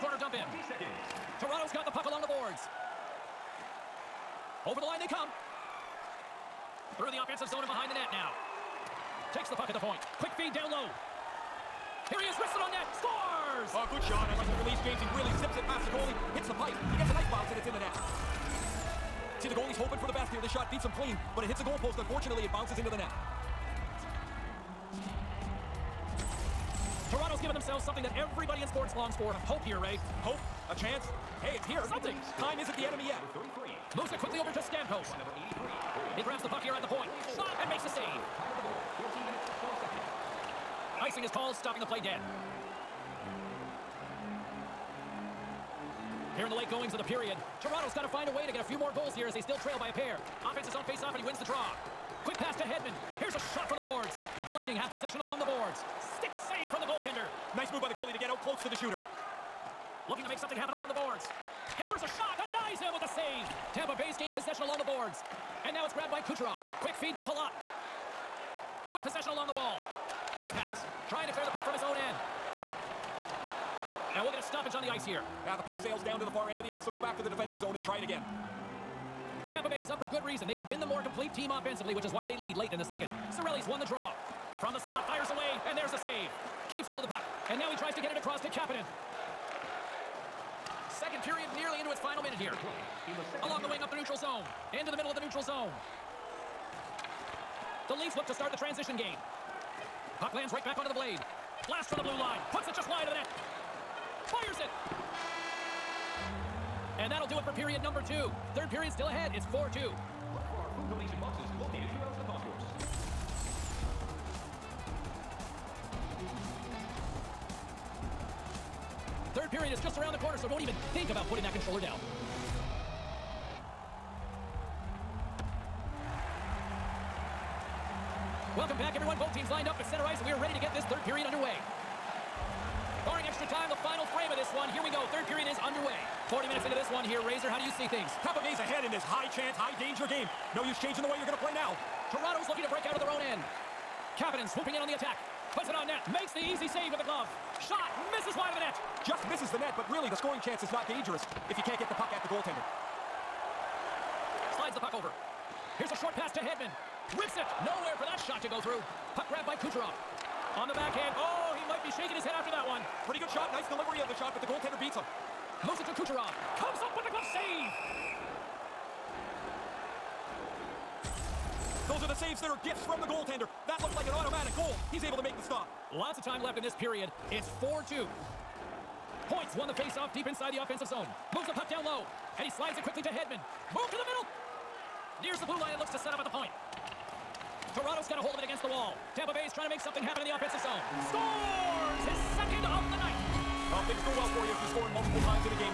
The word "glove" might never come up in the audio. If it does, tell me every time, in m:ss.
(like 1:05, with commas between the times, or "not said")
2:27, 2:47.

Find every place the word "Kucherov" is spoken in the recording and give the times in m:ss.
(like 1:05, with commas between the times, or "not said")
1:06, 2:39, 2:45.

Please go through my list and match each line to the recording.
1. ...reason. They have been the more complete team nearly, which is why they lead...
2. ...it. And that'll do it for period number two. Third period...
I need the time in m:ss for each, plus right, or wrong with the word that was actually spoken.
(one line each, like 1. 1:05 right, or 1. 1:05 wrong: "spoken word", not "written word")
1. 1:20 wrong: "offensively", not "nearly"
2. 1:44 right.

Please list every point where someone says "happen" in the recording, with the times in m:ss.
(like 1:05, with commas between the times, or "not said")
1:00, 3:10.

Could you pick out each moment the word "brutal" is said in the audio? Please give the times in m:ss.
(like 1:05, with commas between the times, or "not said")
not said.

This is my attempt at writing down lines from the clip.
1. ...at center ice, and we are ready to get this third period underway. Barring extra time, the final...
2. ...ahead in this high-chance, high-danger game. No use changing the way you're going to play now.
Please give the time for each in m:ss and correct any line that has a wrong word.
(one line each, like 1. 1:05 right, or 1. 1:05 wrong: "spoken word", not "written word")
1. 2:09 right
2. 2:18 right.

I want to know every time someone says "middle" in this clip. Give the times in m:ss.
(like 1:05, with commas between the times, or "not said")
1:34, 3:04.